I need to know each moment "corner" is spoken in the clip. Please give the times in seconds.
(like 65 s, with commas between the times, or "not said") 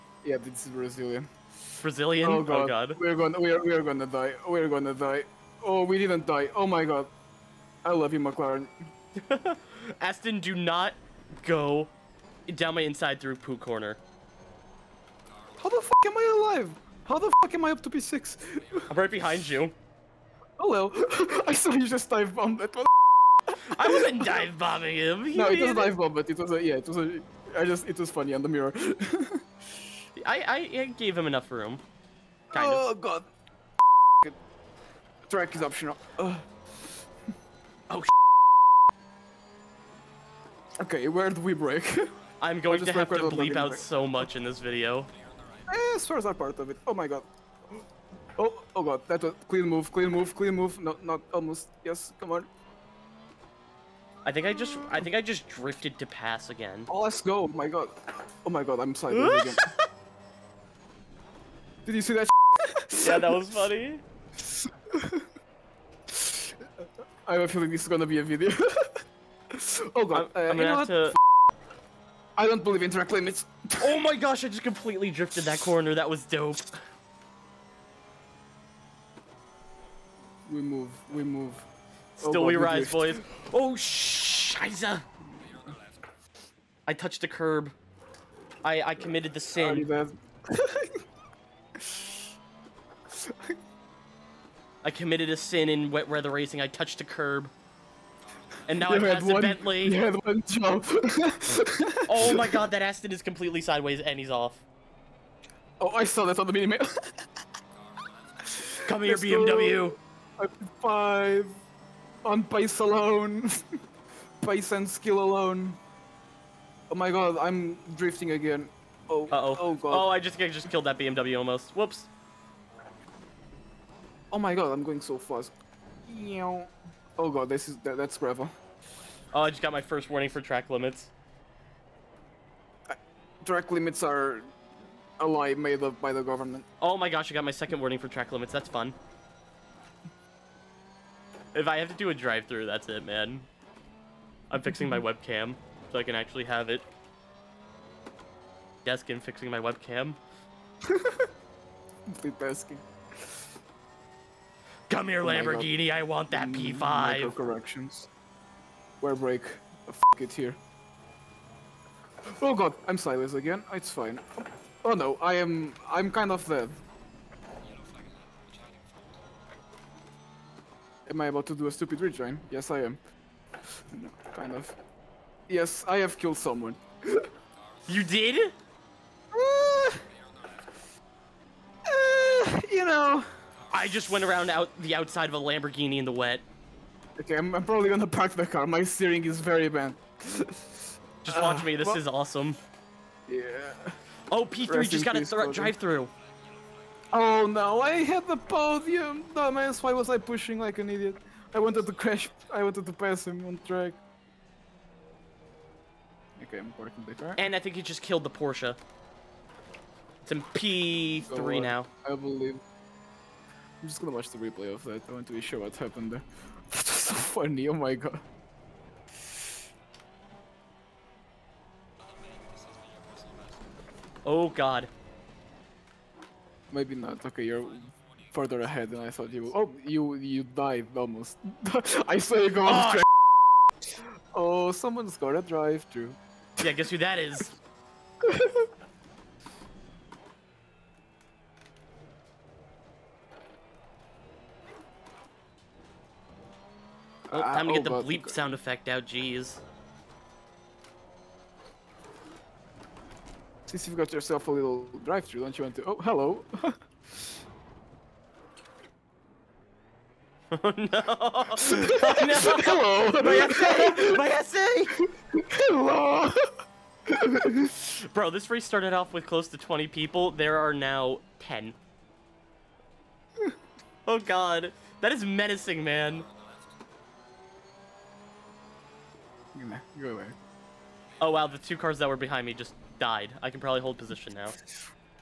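13 s, 75 s.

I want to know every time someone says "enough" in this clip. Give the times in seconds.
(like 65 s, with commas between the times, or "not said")
31 s.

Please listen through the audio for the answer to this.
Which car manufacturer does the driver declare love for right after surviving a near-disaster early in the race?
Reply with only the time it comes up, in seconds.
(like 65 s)
8 s.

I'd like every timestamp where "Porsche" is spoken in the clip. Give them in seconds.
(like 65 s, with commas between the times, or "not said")
208 s.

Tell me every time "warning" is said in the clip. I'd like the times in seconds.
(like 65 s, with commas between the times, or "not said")
130 s, 137 s.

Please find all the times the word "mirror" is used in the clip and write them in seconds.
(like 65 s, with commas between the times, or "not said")
28 s.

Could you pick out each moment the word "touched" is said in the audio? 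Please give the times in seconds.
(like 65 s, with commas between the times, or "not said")
86 s, 96 s.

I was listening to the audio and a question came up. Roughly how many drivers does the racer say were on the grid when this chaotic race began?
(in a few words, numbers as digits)
20.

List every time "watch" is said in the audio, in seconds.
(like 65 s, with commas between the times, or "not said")
191 s, 214 s.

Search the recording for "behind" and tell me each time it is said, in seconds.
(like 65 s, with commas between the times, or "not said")
19 s, 282 s.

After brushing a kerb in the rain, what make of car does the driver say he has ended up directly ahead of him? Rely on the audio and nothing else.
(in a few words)
Bentley.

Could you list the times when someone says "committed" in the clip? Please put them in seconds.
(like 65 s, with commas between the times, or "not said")
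88 s, 94 s.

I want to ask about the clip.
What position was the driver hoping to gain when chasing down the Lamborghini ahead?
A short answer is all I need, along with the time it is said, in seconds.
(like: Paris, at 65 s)
P5, at 156 s.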